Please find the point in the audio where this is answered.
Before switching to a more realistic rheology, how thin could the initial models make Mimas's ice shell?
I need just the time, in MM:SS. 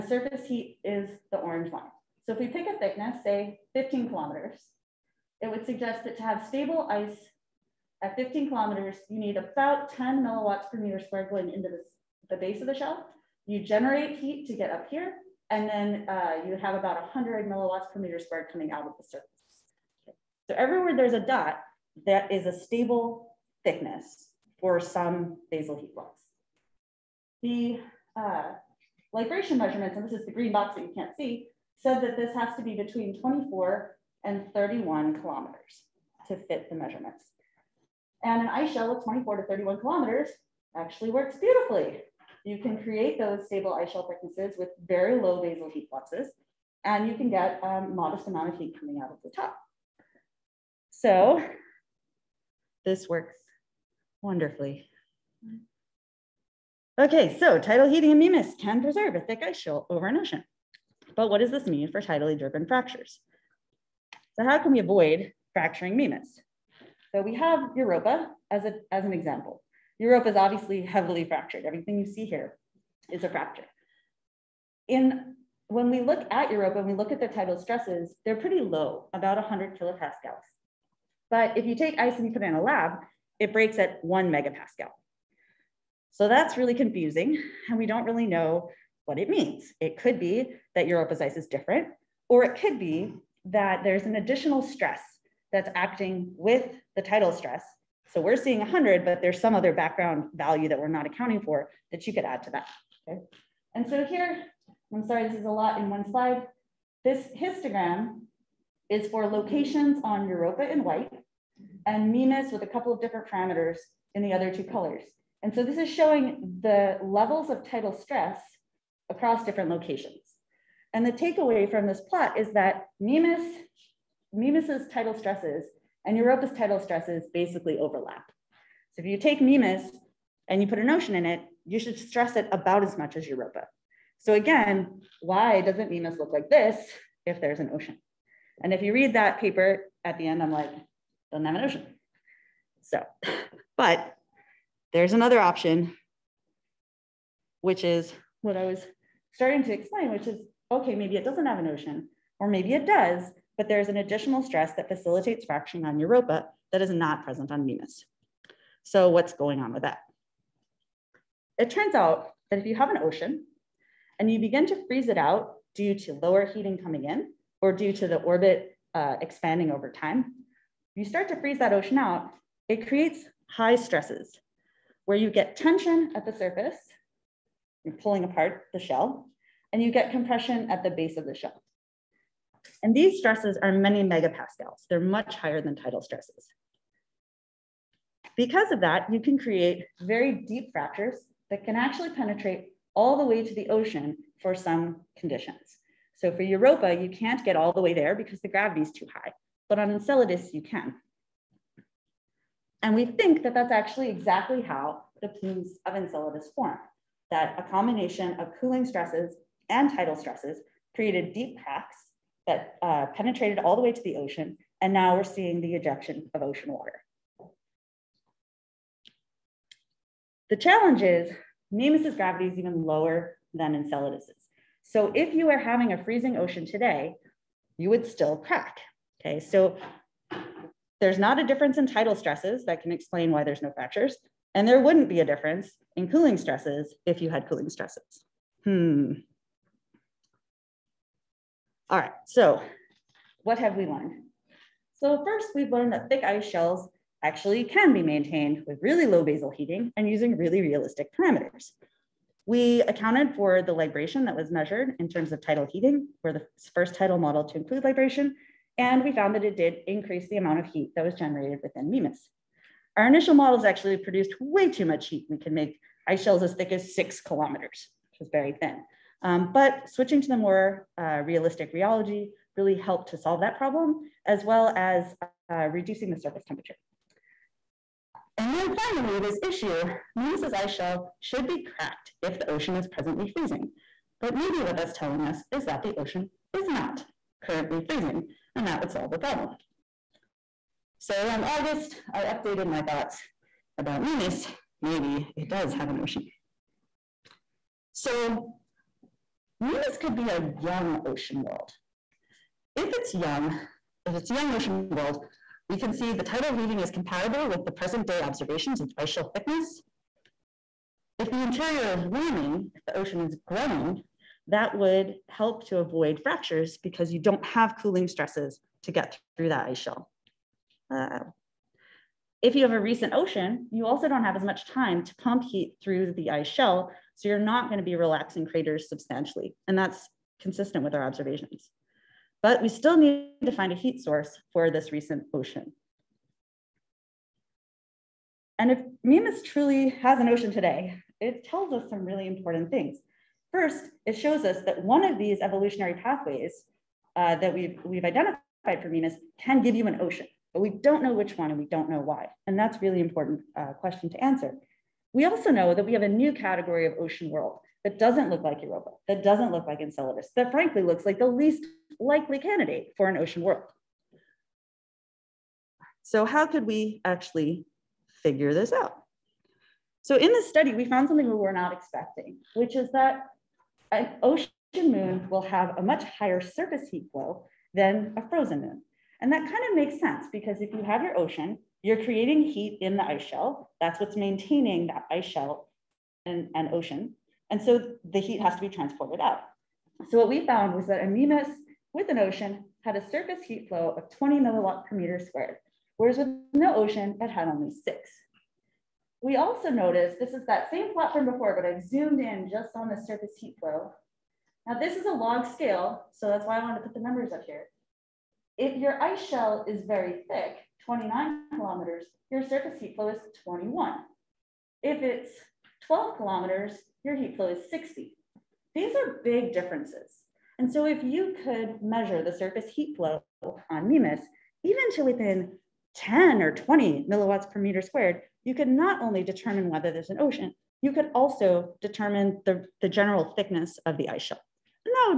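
04:26.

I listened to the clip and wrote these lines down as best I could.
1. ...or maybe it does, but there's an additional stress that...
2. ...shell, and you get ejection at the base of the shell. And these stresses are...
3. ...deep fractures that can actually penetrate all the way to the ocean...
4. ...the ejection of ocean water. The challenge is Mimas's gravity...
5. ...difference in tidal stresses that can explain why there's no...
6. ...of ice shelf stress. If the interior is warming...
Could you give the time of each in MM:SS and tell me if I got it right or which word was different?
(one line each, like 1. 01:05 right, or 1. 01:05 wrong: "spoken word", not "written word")
1. 02:32 right
2. 02:58 wrong: "compression", not "ejection"
3. 03:10 right
4. 03:35 right
5. 03:51 right
6. 05:08 wrong: "thickness", not "stress".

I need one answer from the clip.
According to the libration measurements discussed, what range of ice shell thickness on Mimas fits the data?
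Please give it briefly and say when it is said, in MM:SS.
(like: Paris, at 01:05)
24 to 31 kilometers, at 00:33.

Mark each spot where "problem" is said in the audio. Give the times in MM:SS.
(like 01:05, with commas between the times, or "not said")
04:33, 04:49.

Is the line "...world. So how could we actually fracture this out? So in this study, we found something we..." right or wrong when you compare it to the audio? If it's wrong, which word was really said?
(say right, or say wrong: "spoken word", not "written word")
wrong: "figure", not "fracture".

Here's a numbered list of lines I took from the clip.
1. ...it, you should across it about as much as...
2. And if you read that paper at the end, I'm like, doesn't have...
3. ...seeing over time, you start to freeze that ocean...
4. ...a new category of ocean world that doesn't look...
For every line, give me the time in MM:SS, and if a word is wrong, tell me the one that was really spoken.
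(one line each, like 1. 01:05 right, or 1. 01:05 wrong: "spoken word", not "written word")
1. 02:11 wrong: "stress", not "across"
2. 02:18 right
3. 02:49 wrong: "expanding", not "seeing"
4. 05:56 right.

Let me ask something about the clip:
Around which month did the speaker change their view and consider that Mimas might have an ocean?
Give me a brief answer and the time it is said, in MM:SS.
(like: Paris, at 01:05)
August, at 04:51.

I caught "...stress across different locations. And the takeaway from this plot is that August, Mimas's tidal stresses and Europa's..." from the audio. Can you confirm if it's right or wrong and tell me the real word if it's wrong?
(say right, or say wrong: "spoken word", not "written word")
wrong: "Mimas", not "August".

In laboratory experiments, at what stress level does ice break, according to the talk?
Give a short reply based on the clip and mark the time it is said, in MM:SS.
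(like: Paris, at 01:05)
1 megapascal, at 01:24.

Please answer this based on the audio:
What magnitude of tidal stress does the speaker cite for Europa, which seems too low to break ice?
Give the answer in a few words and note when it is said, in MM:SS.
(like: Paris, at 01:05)
100 kilopascals, at 01:19.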